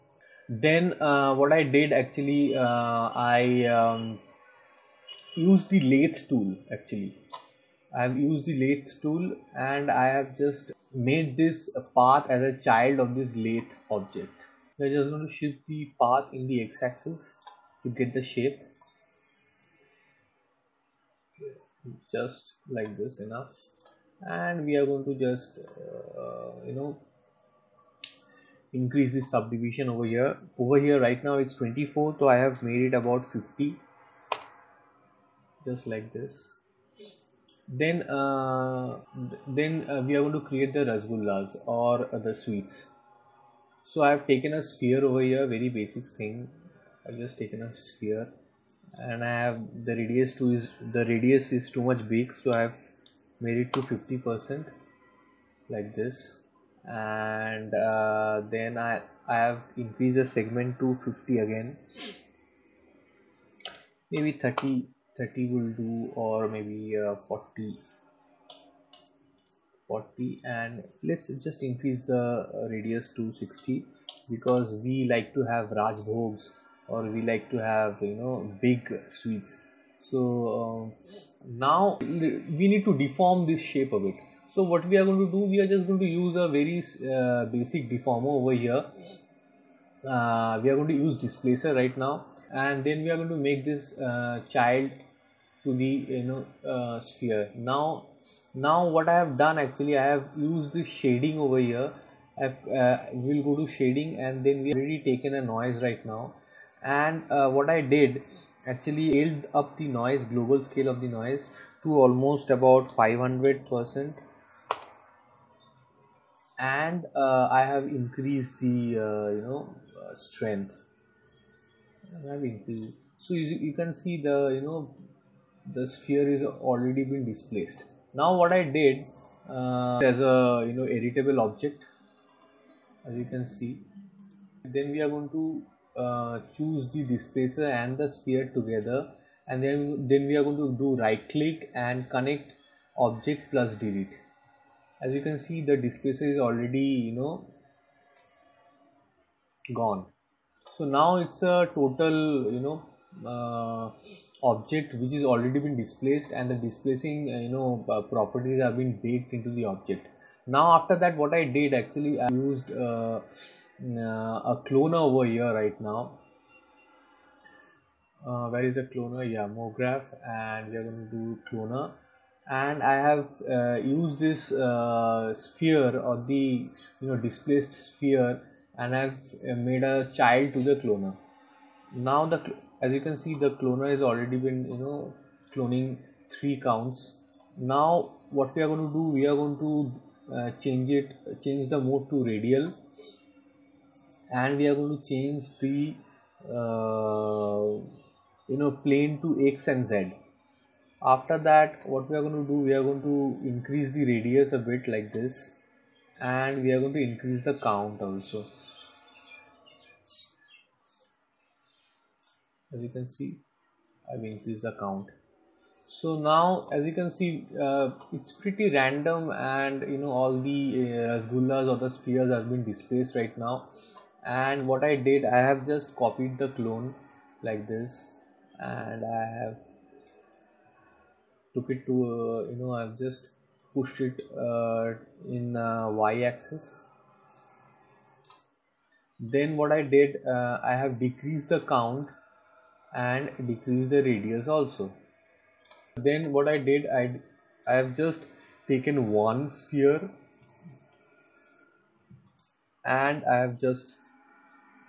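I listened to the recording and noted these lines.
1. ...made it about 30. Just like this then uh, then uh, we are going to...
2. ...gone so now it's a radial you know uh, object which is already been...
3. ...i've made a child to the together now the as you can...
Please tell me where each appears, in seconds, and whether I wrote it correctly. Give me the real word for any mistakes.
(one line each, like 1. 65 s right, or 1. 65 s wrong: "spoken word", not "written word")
1. 32 s wrong: "50", not "30"
2. 149 s wrong: "total", not "radial"
3. 178 s wrong: "cloner", not "together".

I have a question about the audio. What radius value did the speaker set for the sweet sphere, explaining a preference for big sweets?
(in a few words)
60.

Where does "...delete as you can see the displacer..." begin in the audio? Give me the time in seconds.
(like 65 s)
143 s.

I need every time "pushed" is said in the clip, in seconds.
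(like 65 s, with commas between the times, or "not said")
233 s.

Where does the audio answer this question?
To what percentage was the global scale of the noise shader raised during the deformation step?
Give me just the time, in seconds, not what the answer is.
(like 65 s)
112 s.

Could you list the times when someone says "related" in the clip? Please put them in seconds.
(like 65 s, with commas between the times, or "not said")
not said.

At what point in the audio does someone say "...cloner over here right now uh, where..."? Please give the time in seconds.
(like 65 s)
164 s.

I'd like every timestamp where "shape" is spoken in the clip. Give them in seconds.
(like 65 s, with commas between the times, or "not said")
18 s, 83 s.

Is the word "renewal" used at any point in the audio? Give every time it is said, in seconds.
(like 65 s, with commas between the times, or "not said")
not said.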